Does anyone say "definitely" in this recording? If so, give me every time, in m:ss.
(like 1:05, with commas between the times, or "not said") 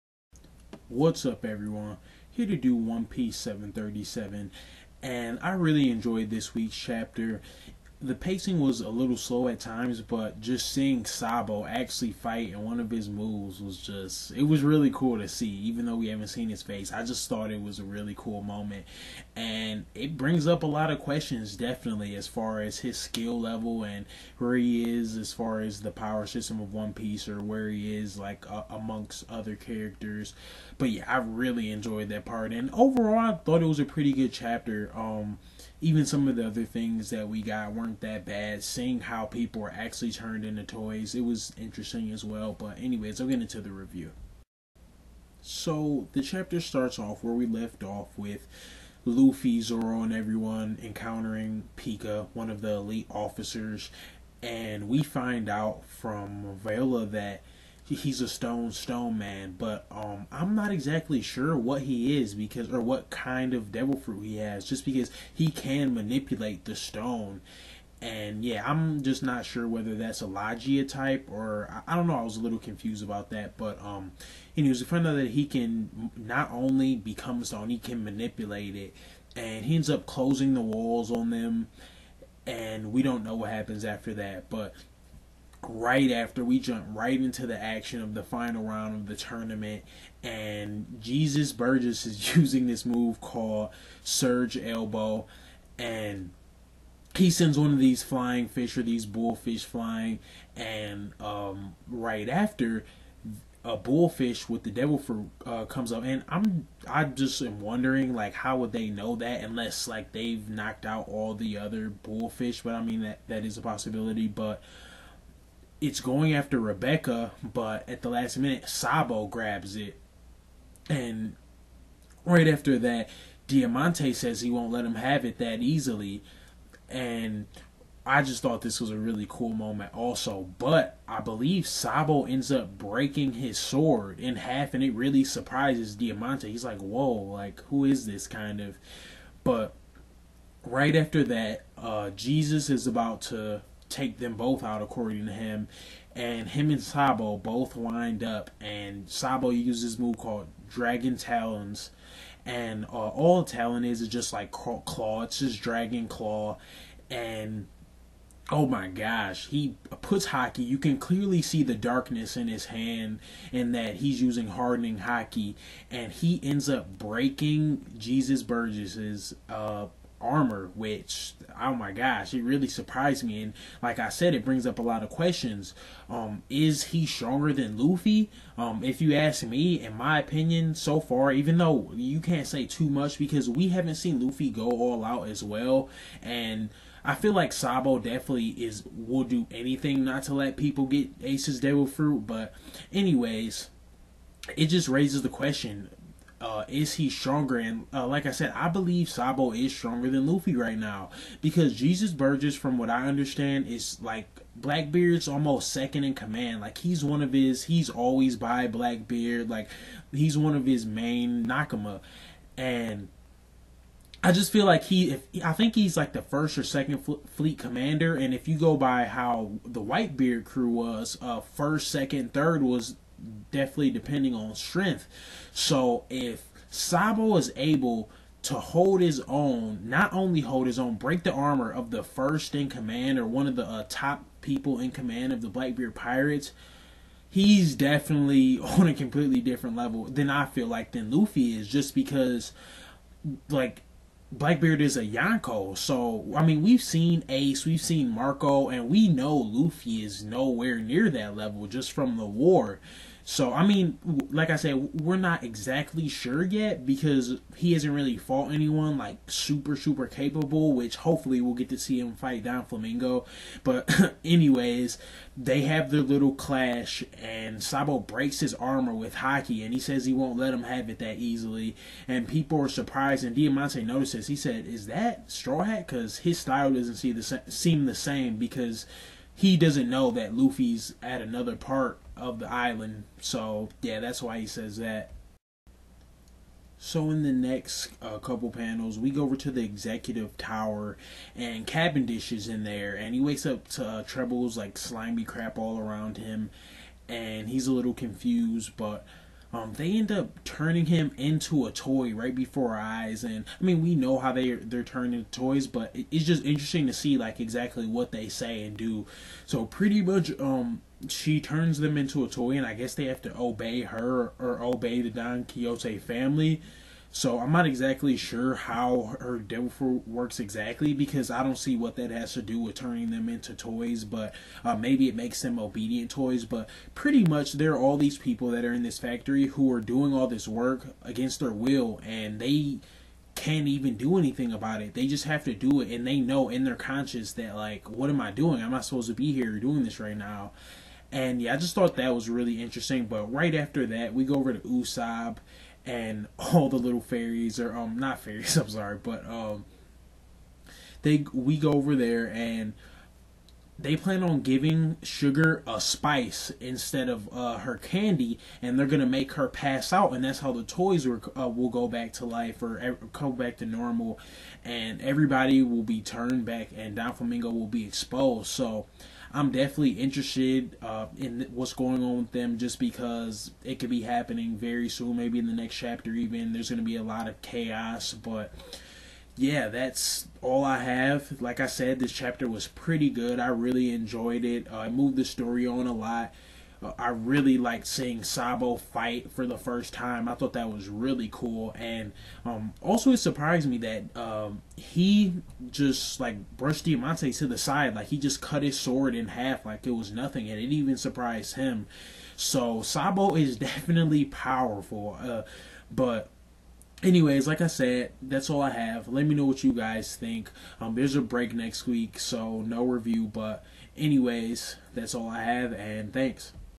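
0:21, 3:07, 3:43, 3:57, 6:09, 6:43.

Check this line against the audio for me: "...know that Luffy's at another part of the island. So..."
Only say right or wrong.
right.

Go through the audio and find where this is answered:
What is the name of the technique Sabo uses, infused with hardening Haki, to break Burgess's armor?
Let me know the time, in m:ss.
2:30.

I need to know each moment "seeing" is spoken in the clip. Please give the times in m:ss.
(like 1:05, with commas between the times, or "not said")
0:10, 0:38, 6:27.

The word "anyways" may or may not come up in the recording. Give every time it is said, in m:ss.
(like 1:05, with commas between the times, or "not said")
0:42, 1:14, 3:12, 4:24, 6:47, 6:53.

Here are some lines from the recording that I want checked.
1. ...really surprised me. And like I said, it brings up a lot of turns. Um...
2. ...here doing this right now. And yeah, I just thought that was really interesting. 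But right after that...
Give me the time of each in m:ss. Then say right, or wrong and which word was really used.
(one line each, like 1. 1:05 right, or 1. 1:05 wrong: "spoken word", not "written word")
1. 2:52 wrong: "questions", not "turns"
2. 5:39 right.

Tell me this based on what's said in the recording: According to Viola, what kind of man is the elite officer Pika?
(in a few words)
stone stone man.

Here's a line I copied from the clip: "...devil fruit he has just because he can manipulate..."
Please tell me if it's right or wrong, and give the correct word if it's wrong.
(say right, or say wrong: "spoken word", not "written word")
right.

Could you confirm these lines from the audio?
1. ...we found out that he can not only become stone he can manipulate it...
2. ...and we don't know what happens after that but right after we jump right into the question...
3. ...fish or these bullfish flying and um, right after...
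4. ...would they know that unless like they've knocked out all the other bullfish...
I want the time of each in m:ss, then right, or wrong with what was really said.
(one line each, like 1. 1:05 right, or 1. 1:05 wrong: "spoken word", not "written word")
1. 1:14 right
2. 1:22 wrong: "action", not "question"
3. 1:38 right
4. 1:48 right.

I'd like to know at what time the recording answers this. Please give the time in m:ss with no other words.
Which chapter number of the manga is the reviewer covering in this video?
0:03.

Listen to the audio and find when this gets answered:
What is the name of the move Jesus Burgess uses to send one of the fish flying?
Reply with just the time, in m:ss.
1:34.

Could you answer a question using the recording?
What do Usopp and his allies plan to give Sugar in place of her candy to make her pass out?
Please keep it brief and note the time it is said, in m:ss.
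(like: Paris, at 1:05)
a spice, at 5:55.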